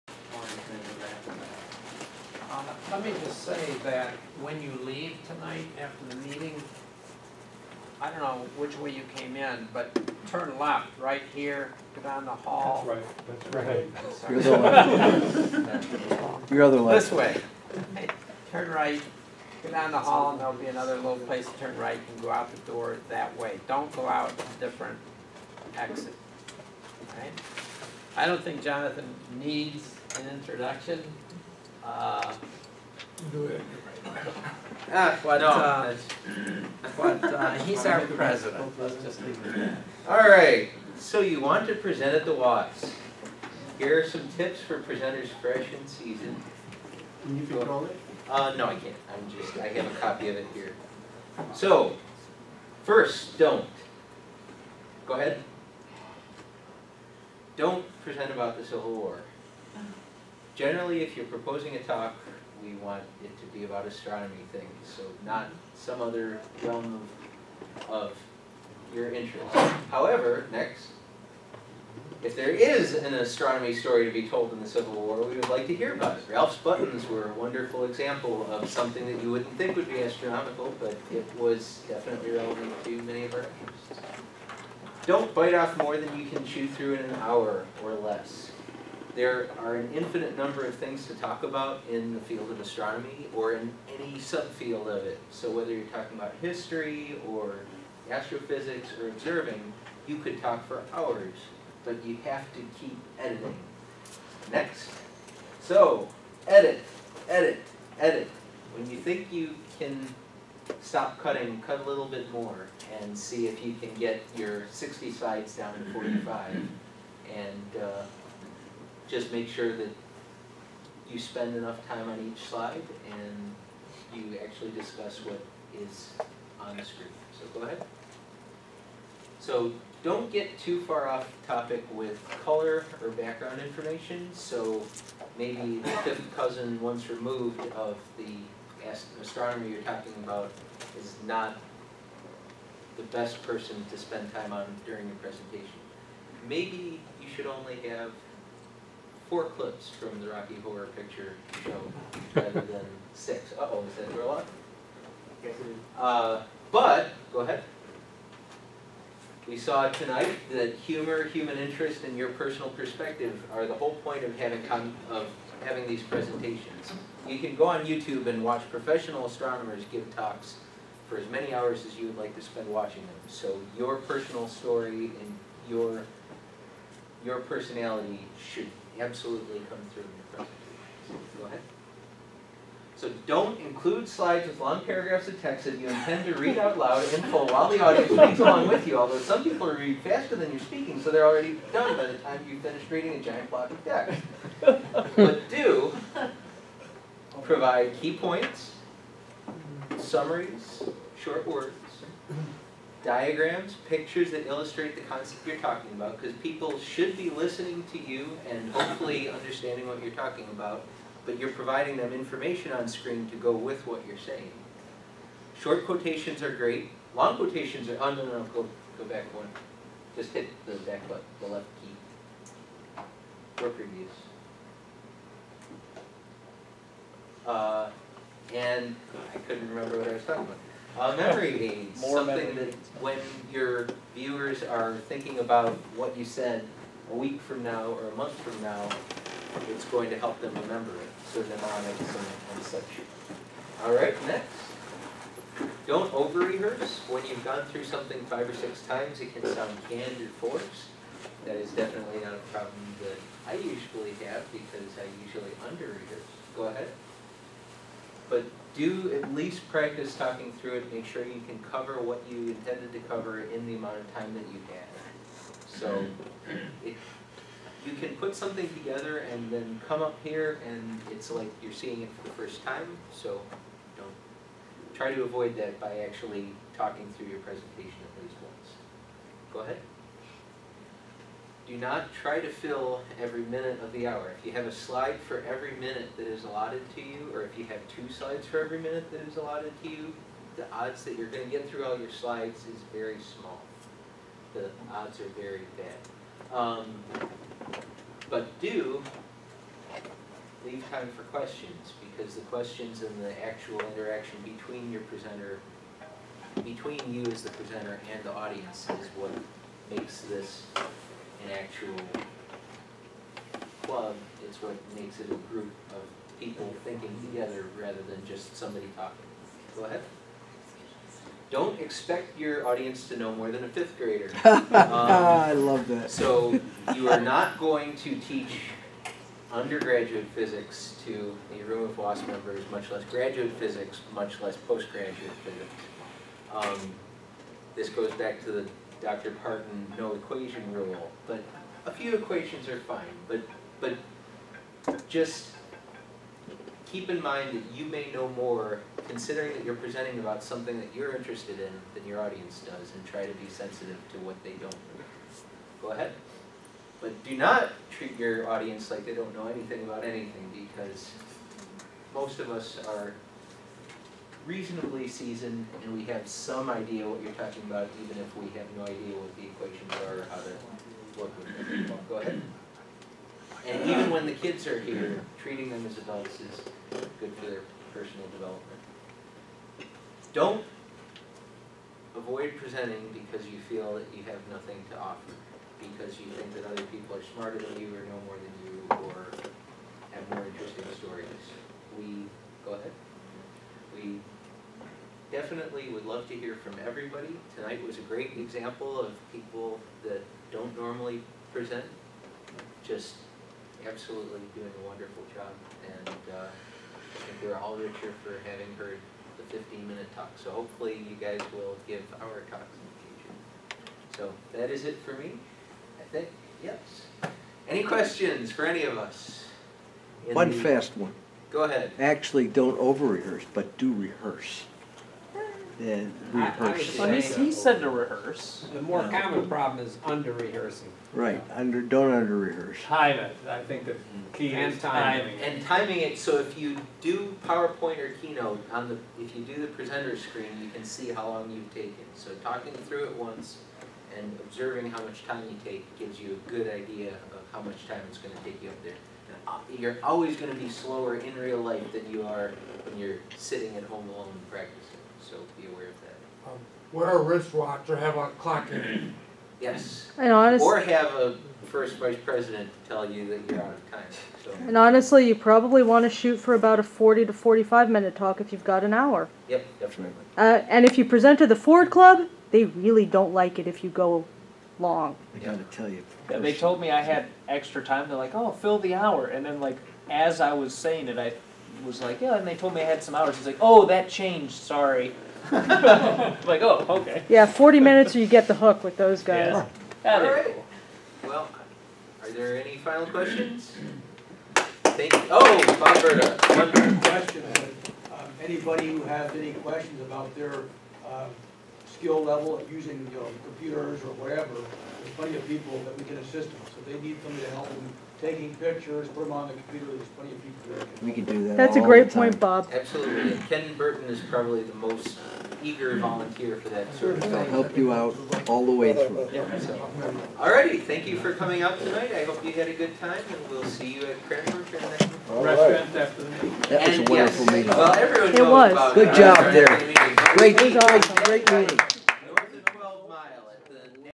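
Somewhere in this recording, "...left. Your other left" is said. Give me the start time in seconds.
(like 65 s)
16 s.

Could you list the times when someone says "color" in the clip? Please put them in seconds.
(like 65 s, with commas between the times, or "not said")
132 s.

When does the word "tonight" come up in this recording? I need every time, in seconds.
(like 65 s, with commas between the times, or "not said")
5 s, 159 s, 397 s, 521 s.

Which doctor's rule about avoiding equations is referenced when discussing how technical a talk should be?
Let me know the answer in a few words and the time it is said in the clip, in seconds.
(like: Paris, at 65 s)
Dr. Parton, at 339 s.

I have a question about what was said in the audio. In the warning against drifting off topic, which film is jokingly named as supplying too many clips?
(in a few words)
Rocky Horror Picture Show.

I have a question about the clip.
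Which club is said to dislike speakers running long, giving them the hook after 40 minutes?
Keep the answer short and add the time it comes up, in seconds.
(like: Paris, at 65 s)
Ford Club, at 471 s.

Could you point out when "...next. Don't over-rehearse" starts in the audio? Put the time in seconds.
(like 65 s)
244 s.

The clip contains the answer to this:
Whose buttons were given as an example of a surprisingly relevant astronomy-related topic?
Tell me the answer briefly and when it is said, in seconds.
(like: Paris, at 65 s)
Ralph, at 76 s.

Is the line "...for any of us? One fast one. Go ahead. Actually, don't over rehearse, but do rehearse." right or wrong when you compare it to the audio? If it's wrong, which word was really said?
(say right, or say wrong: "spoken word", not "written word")
right.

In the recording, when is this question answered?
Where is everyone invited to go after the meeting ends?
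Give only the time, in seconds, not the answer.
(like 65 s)
524 s.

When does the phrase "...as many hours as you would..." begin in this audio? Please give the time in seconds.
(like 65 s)
171 s.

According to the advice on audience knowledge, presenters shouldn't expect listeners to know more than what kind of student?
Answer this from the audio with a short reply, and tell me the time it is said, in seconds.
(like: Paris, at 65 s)
a fifth grader, at 323 s.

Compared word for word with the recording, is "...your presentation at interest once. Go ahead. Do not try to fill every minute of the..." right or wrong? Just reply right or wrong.
wrong.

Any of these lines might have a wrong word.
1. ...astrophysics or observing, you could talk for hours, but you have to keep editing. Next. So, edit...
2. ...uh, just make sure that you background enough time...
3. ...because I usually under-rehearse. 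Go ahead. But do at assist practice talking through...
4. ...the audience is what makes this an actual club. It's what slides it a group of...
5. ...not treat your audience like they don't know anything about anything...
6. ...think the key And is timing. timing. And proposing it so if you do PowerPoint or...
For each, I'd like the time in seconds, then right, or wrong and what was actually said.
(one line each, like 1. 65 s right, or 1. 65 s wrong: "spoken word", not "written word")
1. 98 s right
2. 117 s wrong: "spend", not "background"
3. 254 s wrong: "least", not "assist"
4. 308 s wrong: "makes", not "slides"
5. 357 s right
6. 433 s wrong: "timing", not "proposing".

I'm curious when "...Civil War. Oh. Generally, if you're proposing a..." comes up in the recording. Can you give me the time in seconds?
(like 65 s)
58 s.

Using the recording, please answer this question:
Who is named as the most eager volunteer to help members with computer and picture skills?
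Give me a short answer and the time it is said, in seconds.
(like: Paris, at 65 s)
Ken Bertin, at 513 s.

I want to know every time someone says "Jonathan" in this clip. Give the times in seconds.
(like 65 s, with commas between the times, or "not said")
28 s.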